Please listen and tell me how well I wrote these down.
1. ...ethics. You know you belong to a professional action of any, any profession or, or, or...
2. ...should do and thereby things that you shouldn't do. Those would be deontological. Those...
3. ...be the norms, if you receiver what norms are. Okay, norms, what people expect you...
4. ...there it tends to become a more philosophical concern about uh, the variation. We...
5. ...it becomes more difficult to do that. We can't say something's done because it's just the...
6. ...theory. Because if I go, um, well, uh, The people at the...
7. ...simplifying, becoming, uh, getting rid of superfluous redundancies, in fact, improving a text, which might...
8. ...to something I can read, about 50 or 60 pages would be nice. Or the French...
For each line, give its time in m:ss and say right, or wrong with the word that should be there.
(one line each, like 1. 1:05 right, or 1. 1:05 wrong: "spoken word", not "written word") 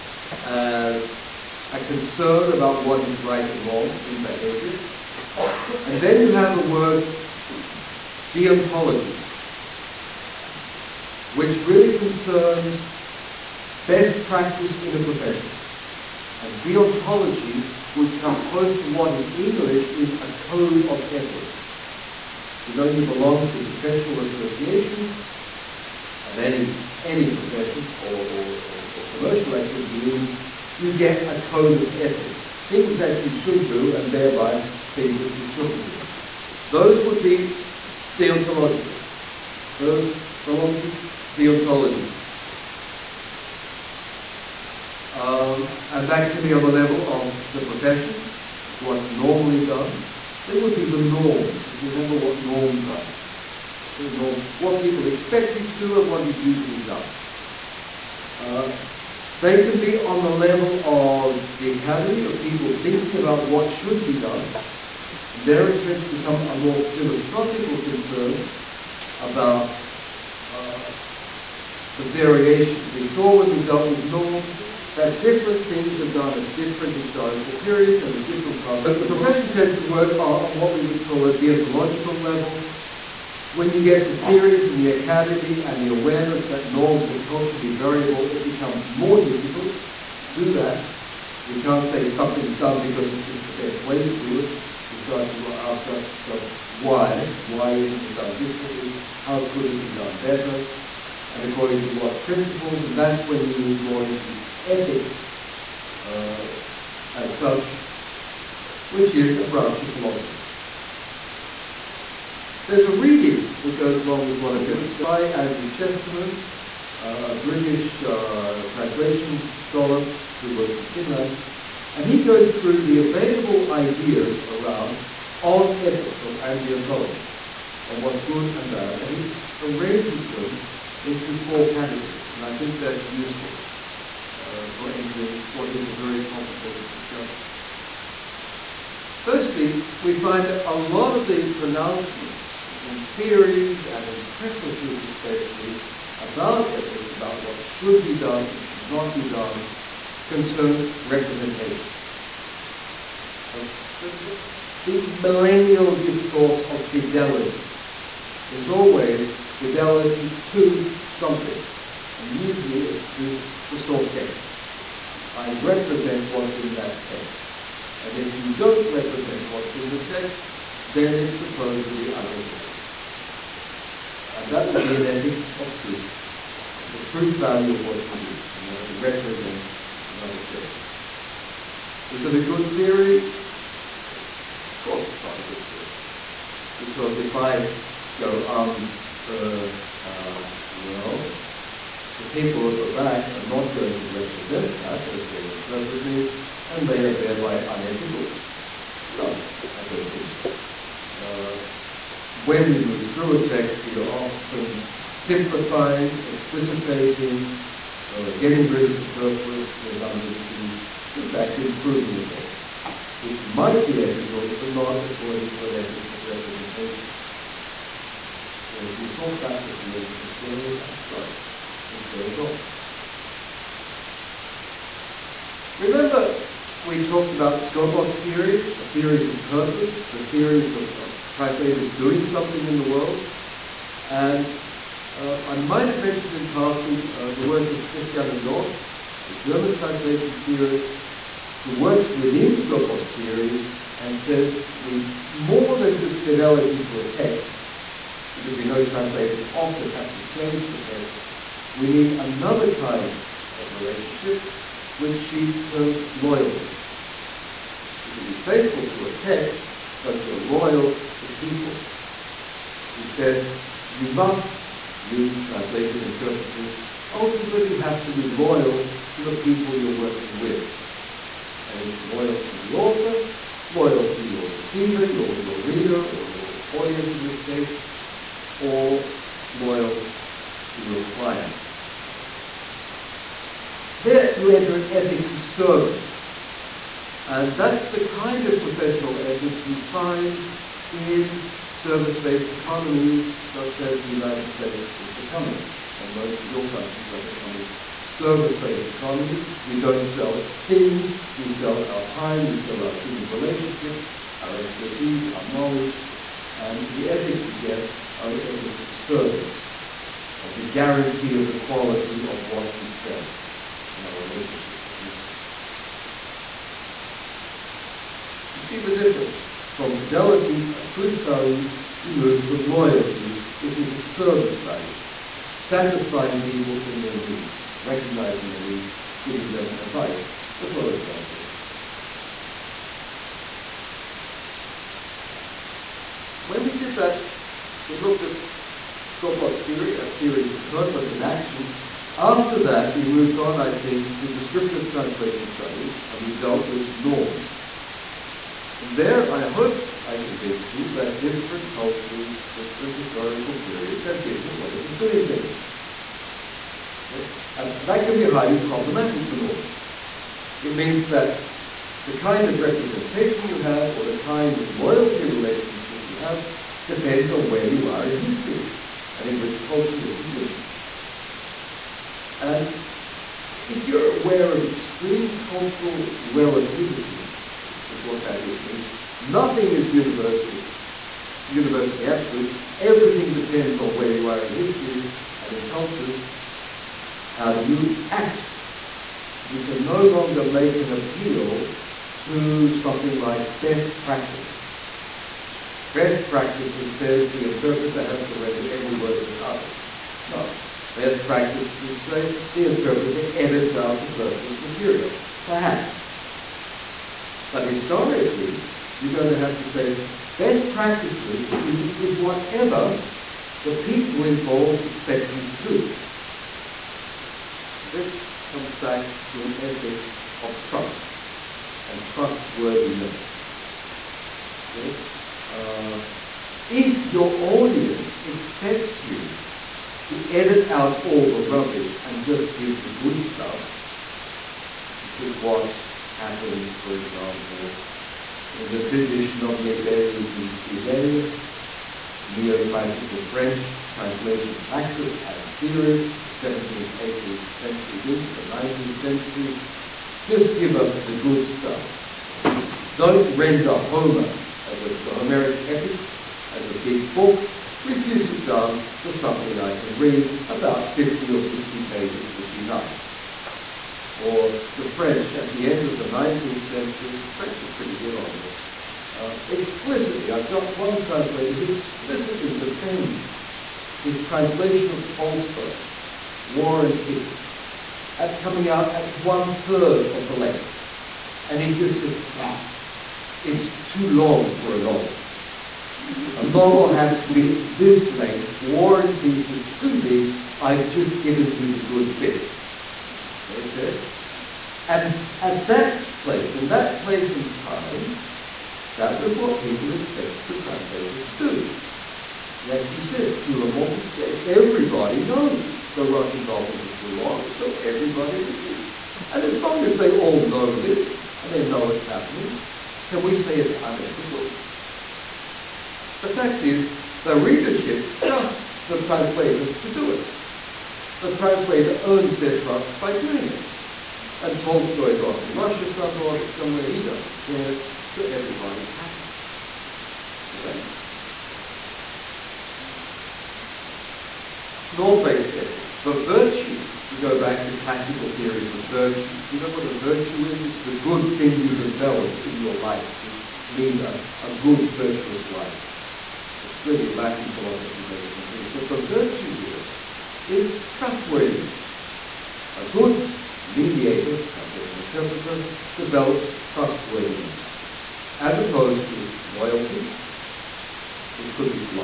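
1. 0:21 wrong: "association", not "action"
2. 0:33 right
3. 0:50 wrong: "remember", not "receiver"
4. 1:05 right
5. 1:28 right
6. 3:05 right
7. 3:25 wrong: "explicitating", not "becoming"
8. 7:39 right.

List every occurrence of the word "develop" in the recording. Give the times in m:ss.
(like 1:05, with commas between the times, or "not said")
9:01, 9:15.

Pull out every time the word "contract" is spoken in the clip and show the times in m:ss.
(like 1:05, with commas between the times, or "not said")
not said.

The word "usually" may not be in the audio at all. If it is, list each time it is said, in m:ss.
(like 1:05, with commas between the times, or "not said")
0:56, 2:42.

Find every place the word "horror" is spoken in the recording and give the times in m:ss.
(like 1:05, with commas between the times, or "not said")
not said.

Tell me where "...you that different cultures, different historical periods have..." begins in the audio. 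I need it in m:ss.
5:50.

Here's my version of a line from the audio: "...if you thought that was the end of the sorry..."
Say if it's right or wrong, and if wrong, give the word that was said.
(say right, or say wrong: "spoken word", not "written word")
wrong: "story", not "sorry".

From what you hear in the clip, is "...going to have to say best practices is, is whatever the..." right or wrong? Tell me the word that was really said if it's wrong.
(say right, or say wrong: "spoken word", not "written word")
right.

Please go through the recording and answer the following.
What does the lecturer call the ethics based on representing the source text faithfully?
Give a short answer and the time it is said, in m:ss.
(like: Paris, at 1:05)
ethics of truth, at 2:55.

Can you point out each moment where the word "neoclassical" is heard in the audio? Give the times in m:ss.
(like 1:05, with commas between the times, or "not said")
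7:22.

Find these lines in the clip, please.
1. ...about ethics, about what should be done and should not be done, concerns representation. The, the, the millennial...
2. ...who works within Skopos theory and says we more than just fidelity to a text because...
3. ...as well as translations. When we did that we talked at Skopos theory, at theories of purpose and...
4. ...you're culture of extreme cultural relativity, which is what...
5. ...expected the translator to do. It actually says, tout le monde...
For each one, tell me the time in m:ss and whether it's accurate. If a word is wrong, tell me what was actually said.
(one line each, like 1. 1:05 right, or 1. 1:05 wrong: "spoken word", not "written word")
1. 2:26 right
2. 4:01 right
3. 5:30 wrong: "looked", not "talked"
4. 6:13 wrong: "aware", not "culture"
5. 8:19 right.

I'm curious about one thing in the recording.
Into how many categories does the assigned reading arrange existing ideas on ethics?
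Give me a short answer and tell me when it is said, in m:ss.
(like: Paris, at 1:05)
4, at 2:11.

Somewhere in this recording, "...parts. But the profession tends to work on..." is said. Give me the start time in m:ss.
1:18.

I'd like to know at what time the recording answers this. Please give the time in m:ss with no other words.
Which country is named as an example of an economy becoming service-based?
4:54.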